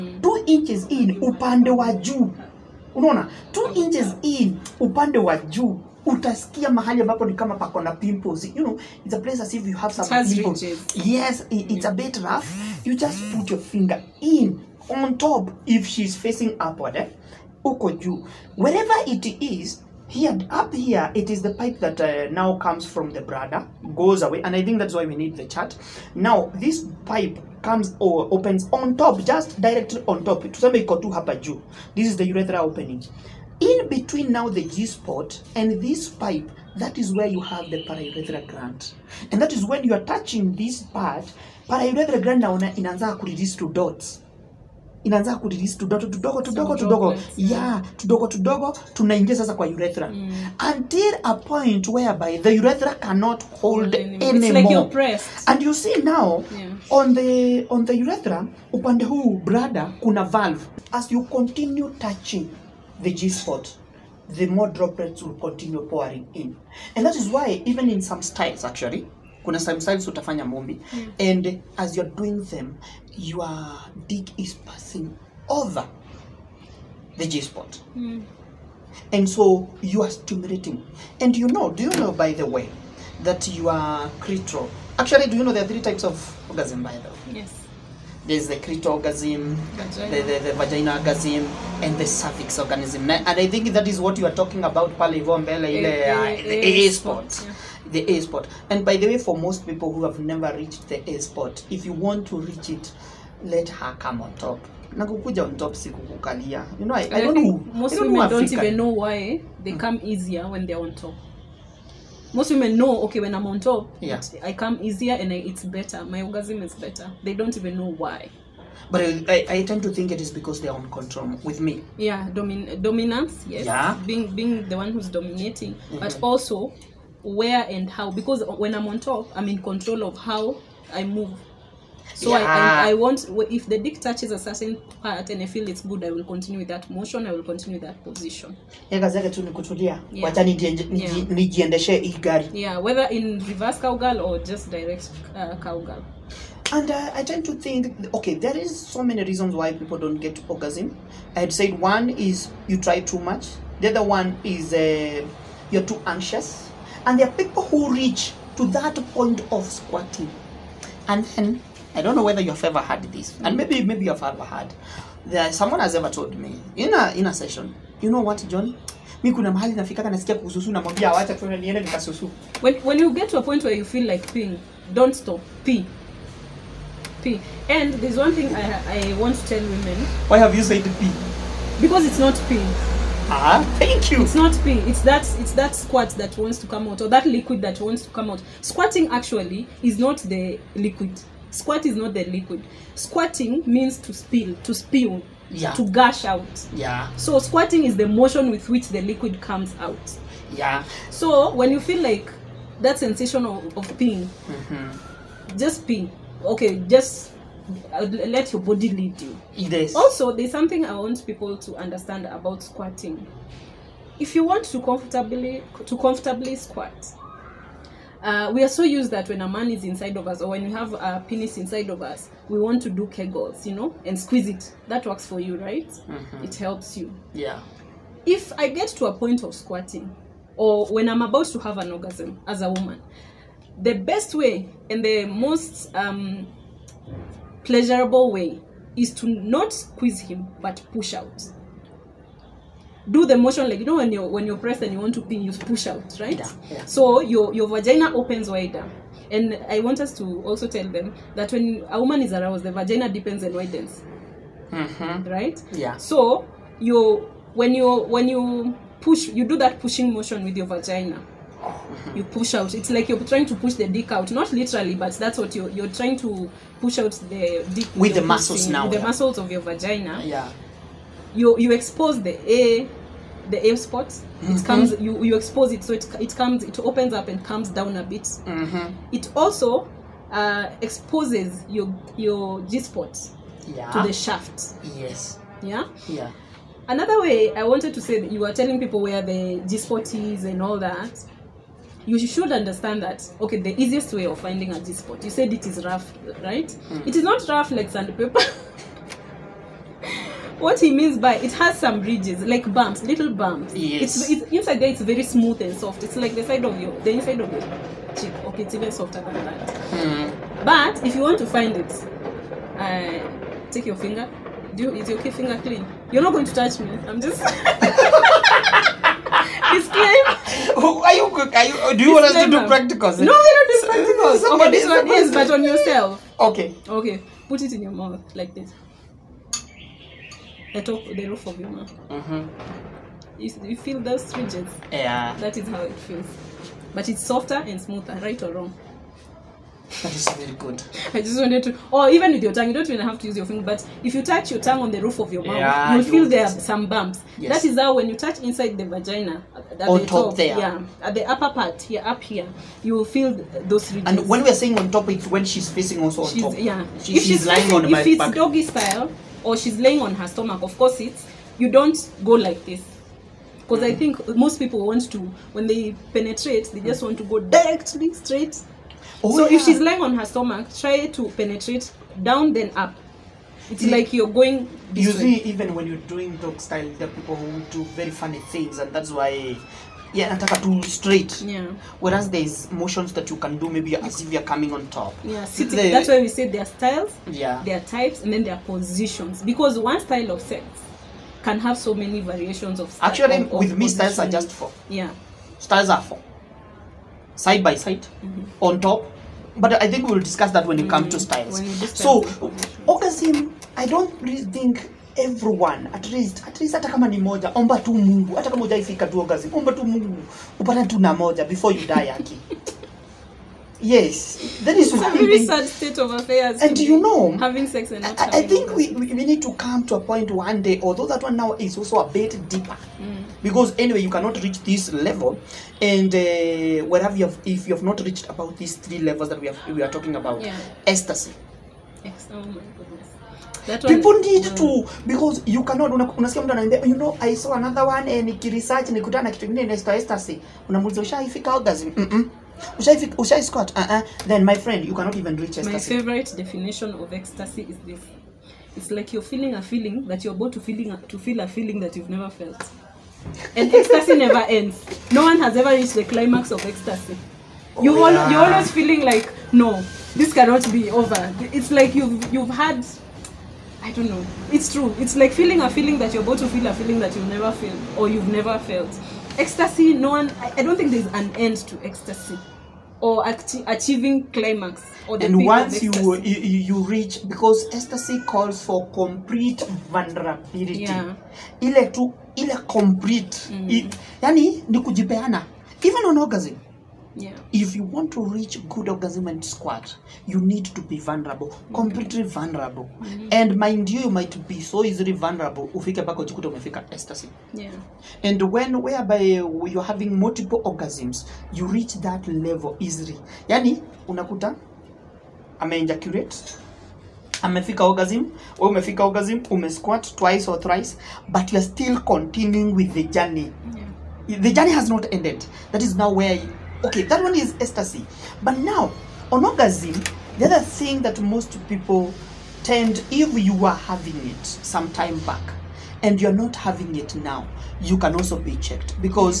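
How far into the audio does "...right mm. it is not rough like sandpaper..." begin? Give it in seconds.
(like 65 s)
296 s.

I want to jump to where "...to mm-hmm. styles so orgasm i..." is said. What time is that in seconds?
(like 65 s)
401 s.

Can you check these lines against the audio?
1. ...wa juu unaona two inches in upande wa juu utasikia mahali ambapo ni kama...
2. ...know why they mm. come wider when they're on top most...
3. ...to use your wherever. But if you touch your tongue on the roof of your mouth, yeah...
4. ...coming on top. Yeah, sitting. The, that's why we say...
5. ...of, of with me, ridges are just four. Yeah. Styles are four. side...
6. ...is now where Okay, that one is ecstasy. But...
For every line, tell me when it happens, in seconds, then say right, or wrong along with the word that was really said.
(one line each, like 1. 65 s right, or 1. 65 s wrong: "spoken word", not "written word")
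1. 1 s right
2. 108 s wrong: "easier", not "wider"
3. 343 s wrong: "finger", not "wherever"
4. 384 s right
5. 393 s wrong: "styles", not "ridges"
6. 515 s right.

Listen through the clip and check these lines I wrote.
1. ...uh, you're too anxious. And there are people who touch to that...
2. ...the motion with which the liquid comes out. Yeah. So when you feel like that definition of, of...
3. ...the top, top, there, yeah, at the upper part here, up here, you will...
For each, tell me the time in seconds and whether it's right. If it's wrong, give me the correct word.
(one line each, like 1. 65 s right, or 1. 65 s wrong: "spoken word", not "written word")
1. 154 s wrong: "reach", not "touch"
2. 197 s wrong: "sensation", not "definition"
3. 350 s right.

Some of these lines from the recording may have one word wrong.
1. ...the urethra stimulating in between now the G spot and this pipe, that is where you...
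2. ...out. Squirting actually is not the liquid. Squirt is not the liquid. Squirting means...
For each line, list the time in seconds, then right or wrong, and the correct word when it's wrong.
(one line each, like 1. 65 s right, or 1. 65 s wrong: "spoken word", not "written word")
1. 32 s wrong: "opening", not "stimulating"
2. 188 s right.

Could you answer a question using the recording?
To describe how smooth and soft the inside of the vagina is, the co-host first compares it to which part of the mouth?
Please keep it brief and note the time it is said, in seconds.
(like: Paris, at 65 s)
inside of your cheek, at 306 s.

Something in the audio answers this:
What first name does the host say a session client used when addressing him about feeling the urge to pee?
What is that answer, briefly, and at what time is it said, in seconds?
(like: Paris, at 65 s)
John, at 168 s.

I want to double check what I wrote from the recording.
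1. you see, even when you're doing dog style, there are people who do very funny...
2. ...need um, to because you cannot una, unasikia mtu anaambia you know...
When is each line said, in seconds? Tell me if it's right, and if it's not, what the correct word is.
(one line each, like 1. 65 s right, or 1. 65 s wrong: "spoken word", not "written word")
1. 374 s right
2. 434 s right.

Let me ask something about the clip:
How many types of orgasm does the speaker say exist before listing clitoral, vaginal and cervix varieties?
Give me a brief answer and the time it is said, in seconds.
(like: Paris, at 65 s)
3, at 85 s.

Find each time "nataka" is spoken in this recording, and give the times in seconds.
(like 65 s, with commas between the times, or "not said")
380 s.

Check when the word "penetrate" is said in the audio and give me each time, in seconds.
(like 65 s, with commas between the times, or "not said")
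366 s, 371 s.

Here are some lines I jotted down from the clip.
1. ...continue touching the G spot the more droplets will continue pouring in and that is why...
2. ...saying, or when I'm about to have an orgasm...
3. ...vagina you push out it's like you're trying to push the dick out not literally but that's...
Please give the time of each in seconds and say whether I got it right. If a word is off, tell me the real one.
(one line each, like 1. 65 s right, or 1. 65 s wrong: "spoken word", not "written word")
1. 61 s right
2. 229 s wrong: "squirting", not "saying"
3. 260 s right.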